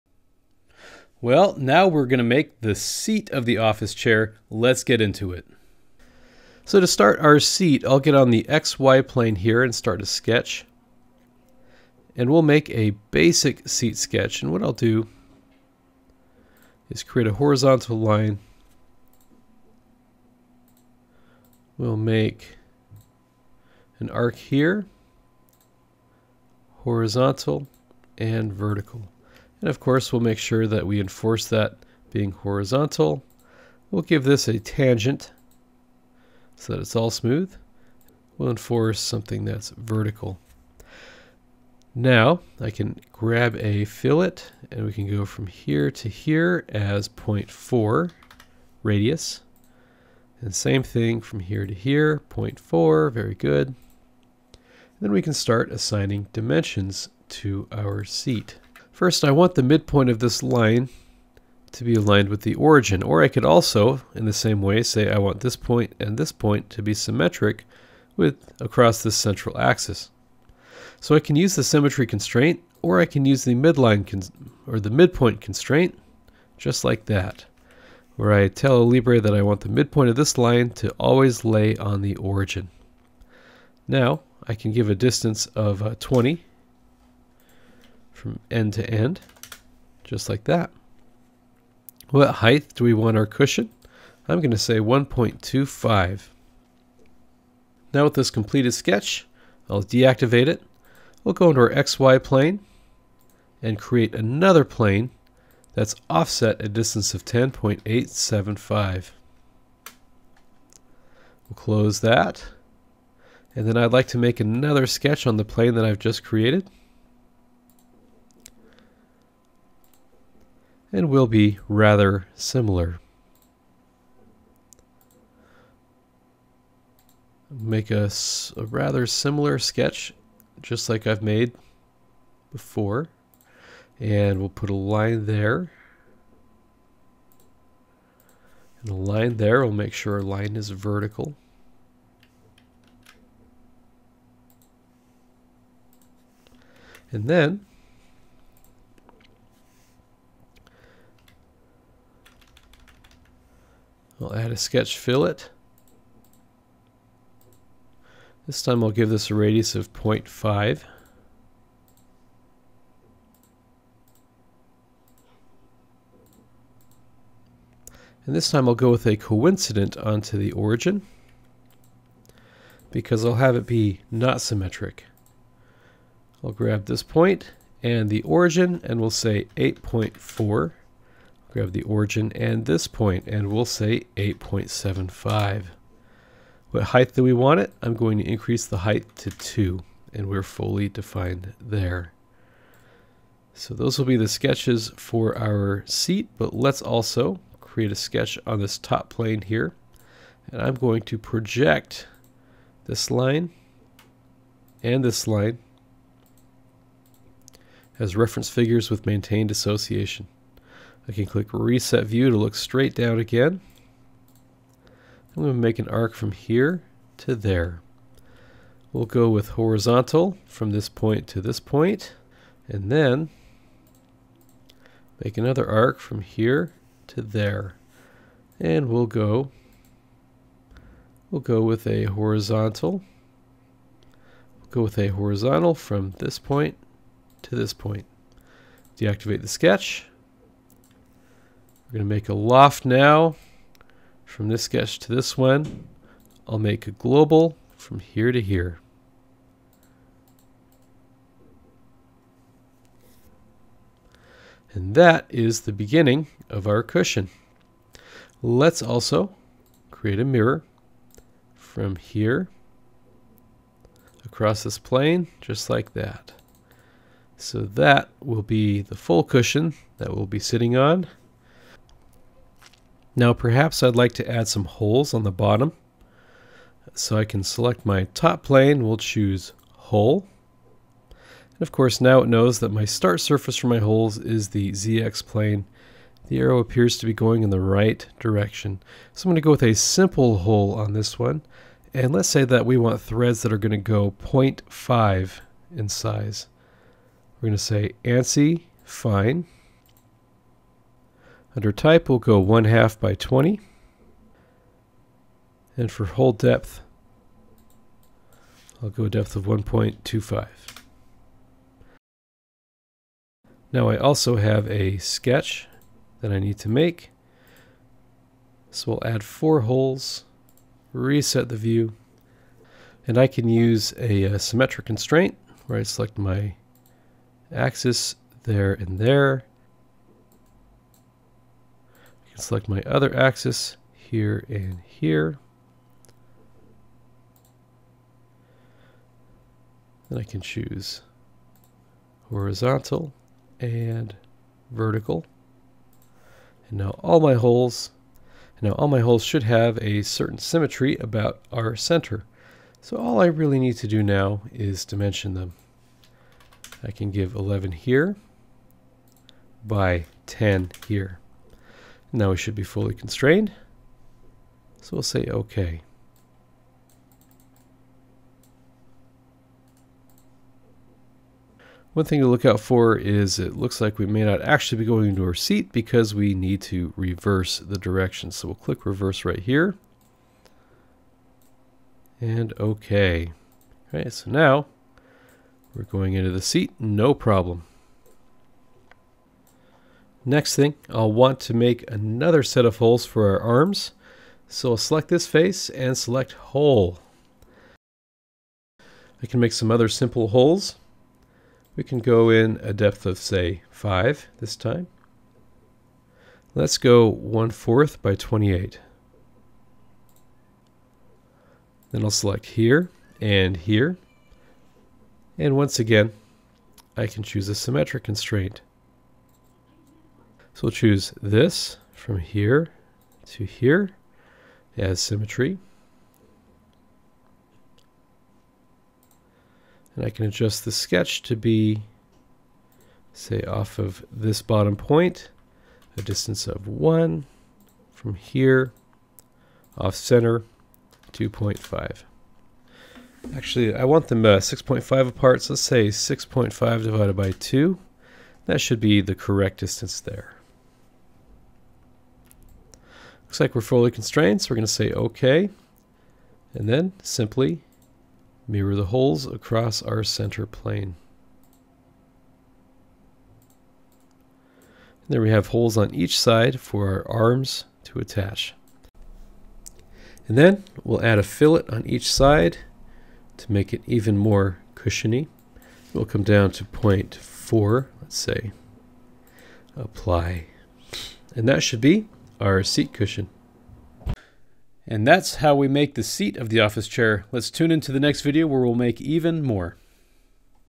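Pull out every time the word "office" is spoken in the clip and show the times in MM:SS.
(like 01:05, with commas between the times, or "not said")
00:03, 08:06.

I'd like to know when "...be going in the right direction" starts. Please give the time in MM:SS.
04:47.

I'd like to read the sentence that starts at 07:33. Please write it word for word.
Looks like we're fully constrained, so we're going to say OK.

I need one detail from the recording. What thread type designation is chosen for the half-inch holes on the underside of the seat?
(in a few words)
ANSI fine.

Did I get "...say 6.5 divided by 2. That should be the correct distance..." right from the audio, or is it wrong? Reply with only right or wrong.
right.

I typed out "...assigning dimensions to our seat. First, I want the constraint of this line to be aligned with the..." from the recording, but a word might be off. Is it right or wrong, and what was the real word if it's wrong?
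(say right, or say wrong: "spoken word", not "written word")
wrong: "midpoint", not "constraint".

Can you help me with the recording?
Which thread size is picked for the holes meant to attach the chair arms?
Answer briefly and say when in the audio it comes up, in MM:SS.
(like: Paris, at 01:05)
1/4 by 28, at 06:47.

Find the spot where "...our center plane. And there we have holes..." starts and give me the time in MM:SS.
07:39.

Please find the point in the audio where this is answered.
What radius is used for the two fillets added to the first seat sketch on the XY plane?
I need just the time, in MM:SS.
00:47.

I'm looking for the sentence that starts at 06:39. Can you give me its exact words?
I can make some other simple holes.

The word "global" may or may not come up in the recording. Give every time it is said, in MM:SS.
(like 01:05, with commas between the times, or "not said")
04:06.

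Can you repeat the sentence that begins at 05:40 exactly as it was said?
Then I can choose horizontal and vertical.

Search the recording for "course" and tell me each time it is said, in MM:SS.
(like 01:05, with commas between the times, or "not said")
00:29, 04:41.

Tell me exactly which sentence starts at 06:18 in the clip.
So we'll click reverse right here.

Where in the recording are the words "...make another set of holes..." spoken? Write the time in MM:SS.
06:31.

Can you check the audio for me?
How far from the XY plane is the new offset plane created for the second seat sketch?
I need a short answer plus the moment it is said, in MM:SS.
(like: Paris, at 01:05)
10.875, at 01:47.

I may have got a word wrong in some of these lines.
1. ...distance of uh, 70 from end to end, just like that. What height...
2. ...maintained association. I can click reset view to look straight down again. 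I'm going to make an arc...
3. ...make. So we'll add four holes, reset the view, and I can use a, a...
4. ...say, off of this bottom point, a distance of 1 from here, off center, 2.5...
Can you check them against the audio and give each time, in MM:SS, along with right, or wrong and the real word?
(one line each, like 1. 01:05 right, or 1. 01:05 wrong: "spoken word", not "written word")
1. 01:24 wrong: "20", not "70"
2. 03:29 right
3. 05:16 right
4. 07:13 right.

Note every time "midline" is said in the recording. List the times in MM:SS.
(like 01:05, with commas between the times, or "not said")
01:13.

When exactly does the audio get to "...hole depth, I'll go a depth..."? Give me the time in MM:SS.
05:06.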